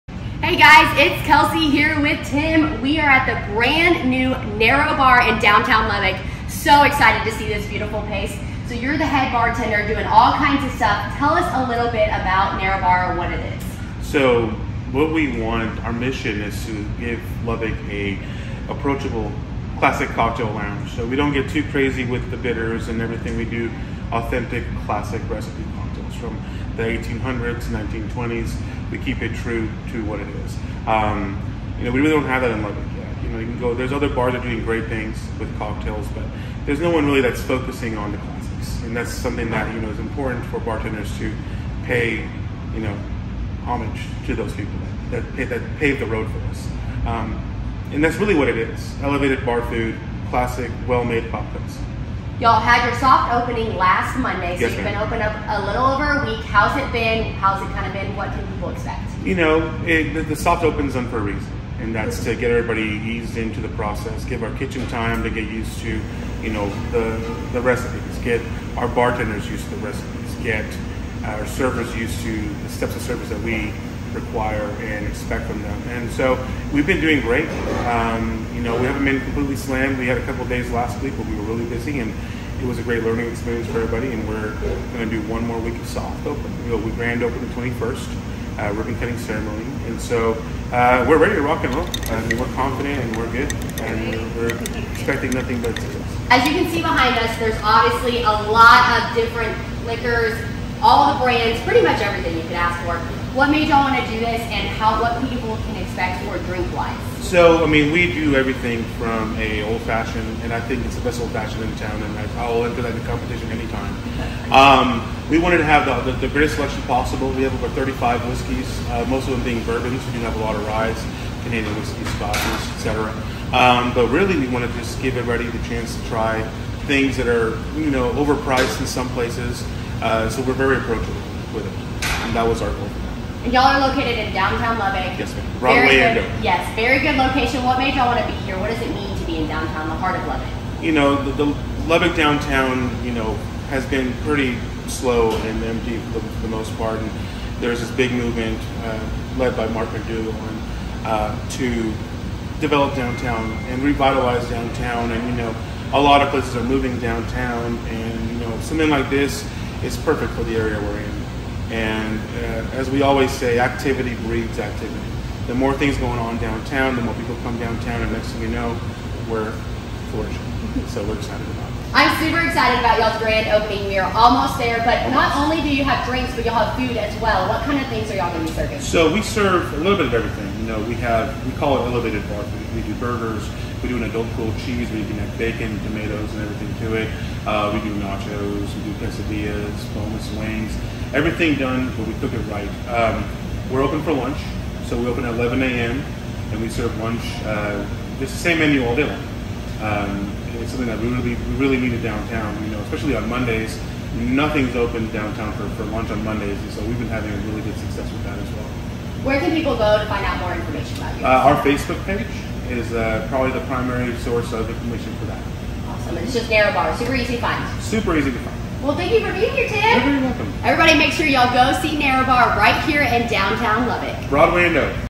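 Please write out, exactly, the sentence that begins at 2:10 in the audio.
Uh, so we're very approachable with it, and that was our goal.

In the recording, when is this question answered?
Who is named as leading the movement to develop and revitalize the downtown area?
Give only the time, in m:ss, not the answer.
2:29.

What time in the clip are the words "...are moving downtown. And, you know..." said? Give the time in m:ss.
2:36.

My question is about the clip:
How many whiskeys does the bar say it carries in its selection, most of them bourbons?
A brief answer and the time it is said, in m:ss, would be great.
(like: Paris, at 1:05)
Over 35, at 1:57.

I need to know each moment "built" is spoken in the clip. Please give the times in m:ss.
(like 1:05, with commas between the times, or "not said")
not said.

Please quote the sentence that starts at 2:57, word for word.
What kind of things are y'all going to be serving?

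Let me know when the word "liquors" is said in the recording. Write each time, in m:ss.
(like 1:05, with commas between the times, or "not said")
1:39.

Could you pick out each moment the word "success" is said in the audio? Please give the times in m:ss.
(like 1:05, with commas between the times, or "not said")
1:35, 3:27.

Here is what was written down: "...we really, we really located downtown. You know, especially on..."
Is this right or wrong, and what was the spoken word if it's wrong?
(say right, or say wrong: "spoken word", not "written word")
wrong: "needed", not "located".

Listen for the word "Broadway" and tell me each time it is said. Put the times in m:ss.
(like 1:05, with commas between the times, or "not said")
2:15, 3:44.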